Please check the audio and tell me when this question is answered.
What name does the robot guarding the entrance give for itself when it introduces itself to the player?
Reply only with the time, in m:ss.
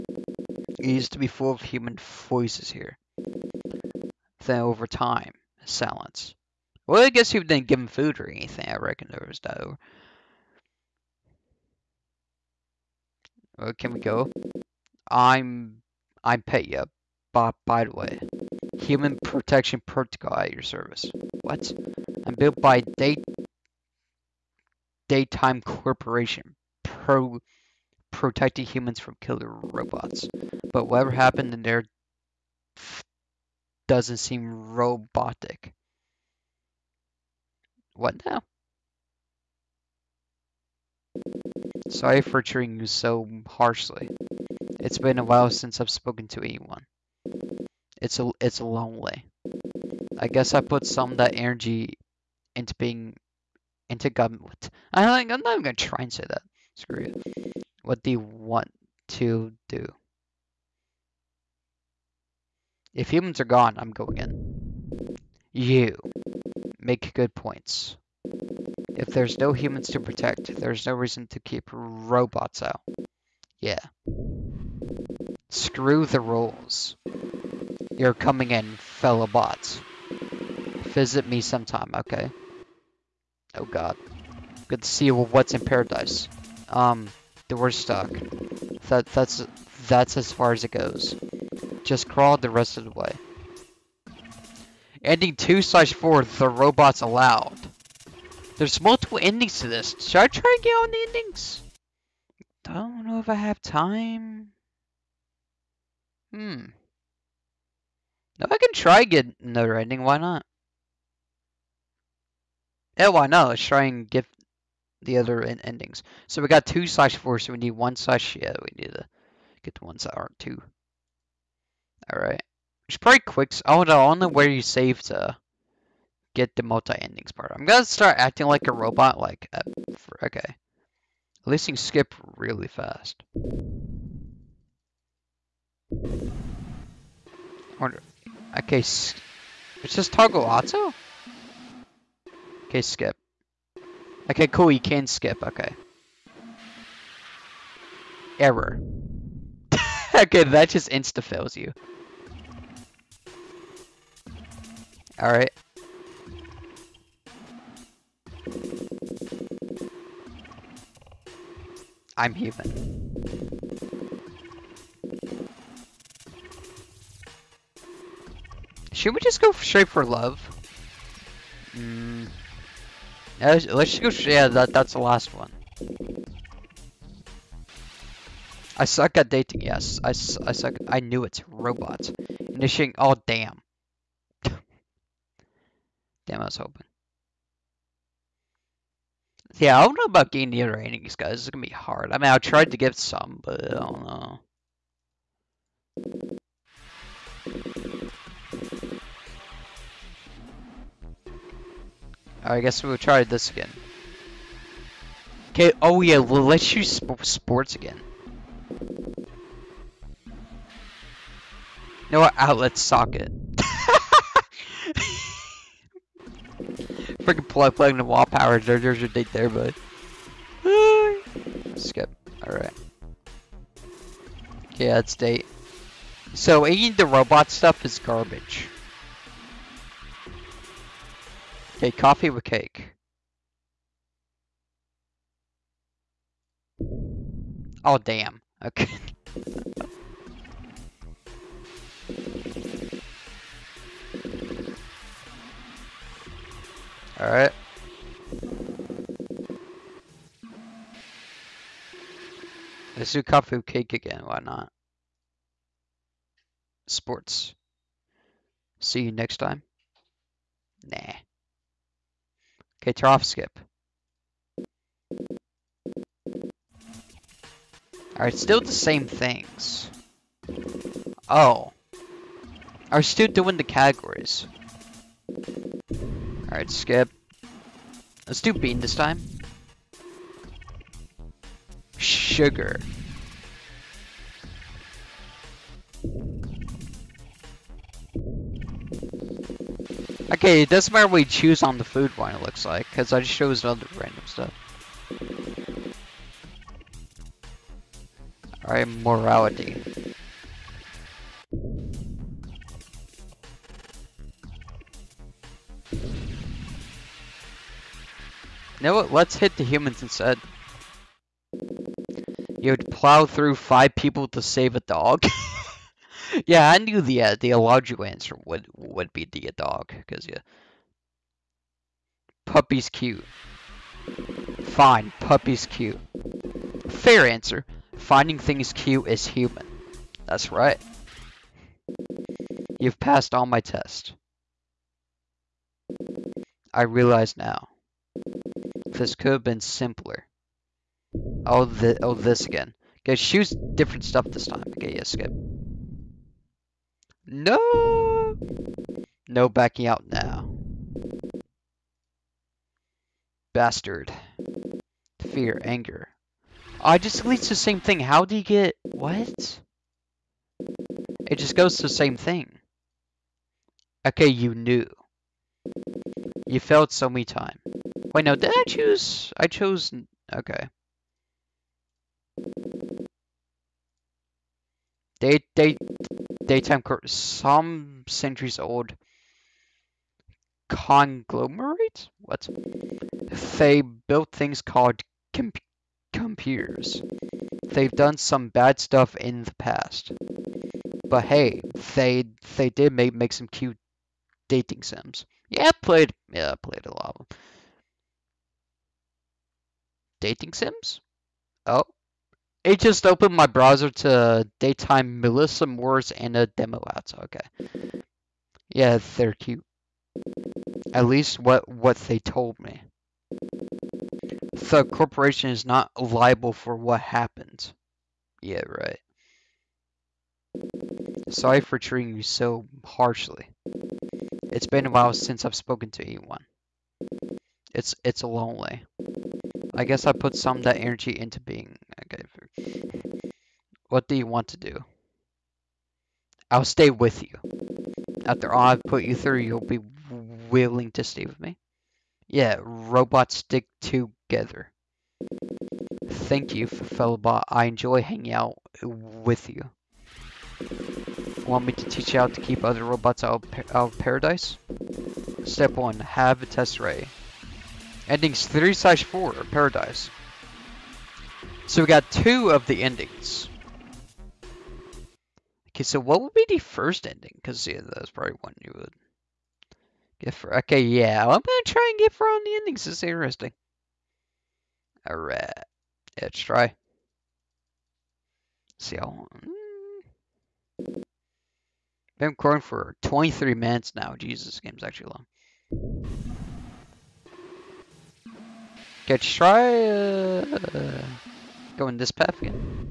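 0:16.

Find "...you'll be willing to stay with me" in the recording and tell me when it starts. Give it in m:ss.
7:19.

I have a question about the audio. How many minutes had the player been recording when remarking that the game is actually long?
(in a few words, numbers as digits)
23 minutes.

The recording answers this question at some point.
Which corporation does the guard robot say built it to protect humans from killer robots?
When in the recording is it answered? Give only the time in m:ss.
0:22.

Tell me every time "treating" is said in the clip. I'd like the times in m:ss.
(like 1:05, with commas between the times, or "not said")
0:42, 7:01.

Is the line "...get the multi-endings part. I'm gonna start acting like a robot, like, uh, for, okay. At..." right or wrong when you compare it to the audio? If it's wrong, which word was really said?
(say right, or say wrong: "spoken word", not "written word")
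right.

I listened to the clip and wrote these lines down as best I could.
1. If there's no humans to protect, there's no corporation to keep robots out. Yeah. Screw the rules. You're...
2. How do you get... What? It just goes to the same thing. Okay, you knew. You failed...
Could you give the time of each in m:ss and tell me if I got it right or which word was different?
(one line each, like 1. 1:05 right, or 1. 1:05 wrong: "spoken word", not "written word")
1. 1:08 wrong: "reason", not "corporation"
2. 5:57 right.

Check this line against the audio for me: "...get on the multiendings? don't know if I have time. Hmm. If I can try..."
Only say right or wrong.
wrong.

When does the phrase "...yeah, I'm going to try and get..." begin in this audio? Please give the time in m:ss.
7:50.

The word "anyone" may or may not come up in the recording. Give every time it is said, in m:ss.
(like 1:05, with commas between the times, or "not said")
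0:46, 7:06.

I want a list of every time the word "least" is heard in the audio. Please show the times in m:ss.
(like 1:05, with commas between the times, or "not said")
2:11, 6:51.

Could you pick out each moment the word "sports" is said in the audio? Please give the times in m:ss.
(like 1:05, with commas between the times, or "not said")
3:27, 4:16.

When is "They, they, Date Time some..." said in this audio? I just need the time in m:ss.
6:15.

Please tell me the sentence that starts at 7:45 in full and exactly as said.
Okay, so what would be the first ending?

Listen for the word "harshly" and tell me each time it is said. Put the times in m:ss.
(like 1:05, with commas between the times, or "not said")
0:43, 7:02.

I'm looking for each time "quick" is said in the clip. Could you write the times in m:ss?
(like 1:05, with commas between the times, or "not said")
2:03.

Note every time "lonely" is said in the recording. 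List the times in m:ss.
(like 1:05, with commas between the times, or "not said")
0:48, 7:08.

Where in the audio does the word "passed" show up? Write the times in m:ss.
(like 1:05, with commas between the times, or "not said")
5:33.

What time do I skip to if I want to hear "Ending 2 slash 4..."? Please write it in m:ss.
1:35.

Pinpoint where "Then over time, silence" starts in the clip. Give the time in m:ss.
0:04.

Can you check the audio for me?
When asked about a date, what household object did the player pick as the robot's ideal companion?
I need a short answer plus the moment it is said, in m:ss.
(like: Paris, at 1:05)
Outlet socket, at 3:32.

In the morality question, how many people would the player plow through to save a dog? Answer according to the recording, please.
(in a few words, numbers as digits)
5.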